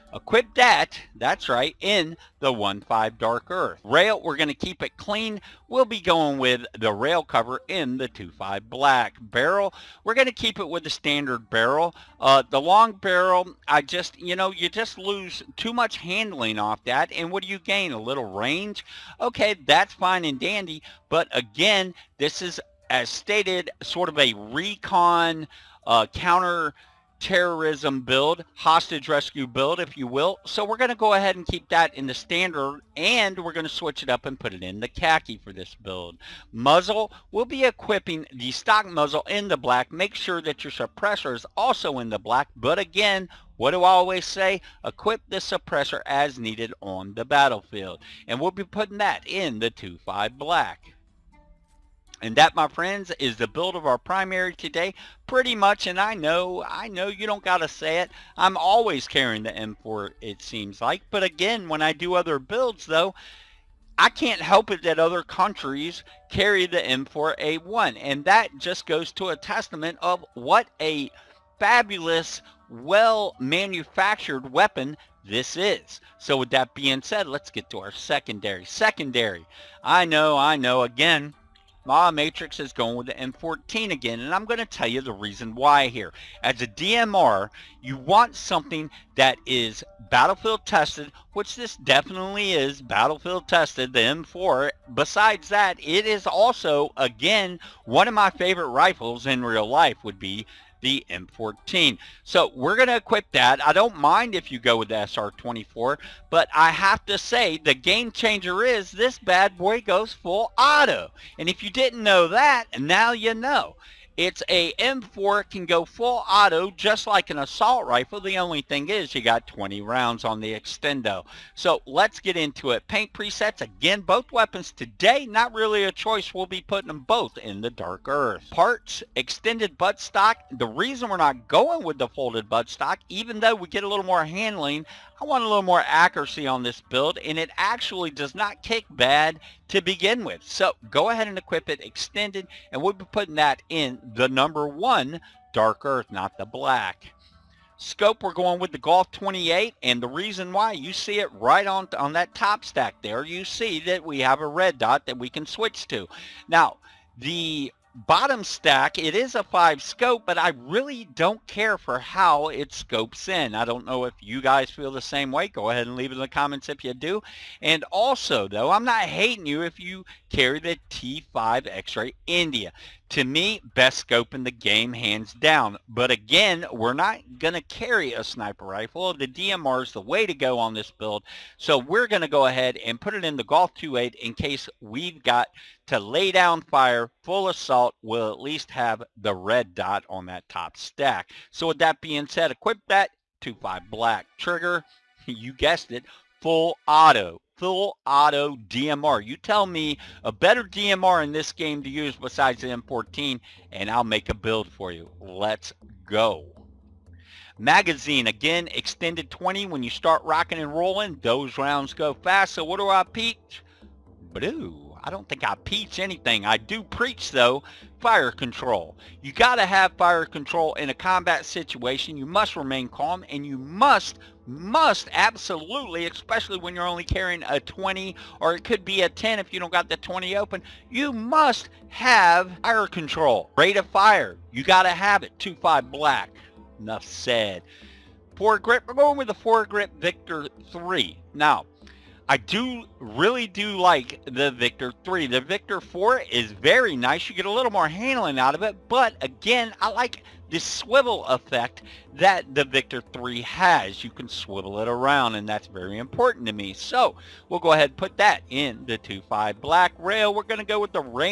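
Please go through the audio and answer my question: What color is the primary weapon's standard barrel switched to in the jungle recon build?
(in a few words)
Khaki.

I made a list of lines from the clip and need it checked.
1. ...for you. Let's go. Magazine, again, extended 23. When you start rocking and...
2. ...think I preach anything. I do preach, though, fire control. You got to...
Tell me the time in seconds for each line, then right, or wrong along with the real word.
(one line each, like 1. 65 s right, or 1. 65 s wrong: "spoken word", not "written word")
1. 204 s wrong: "20", not "23"
2. 215 s right.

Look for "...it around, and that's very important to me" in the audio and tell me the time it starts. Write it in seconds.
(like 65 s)
254 s.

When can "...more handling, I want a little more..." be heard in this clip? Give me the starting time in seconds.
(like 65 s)
134 s.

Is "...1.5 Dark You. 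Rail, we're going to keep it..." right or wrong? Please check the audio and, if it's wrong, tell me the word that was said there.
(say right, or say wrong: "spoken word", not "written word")
wrong: "Earth", not "You".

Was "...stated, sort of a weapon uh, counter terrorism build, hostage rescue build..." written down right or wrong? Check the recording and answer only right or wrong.
wrong.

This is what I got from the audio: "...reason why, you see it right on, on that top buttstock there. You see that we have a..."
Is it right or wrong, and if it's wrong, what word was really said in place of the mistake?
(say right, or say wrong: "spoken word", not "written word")
wrong: "stack", not "buttstock".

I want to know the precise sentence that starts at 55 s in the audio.
Pretty much, and I know, I know you don't got to say it.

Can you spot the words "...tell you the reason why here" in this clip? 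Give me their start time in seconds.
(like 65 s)
84 s.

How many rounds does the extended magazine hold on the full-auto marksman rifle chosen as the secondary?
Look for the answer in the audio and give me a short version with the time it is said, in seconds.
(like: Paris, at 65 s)
20, at 119 s.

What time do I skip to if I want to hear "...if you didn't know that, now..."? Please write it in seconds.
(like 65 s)
111 s.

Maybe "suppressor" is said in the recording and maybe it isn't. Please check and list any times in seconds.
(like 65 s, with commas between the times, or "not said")
40 s, 45 s.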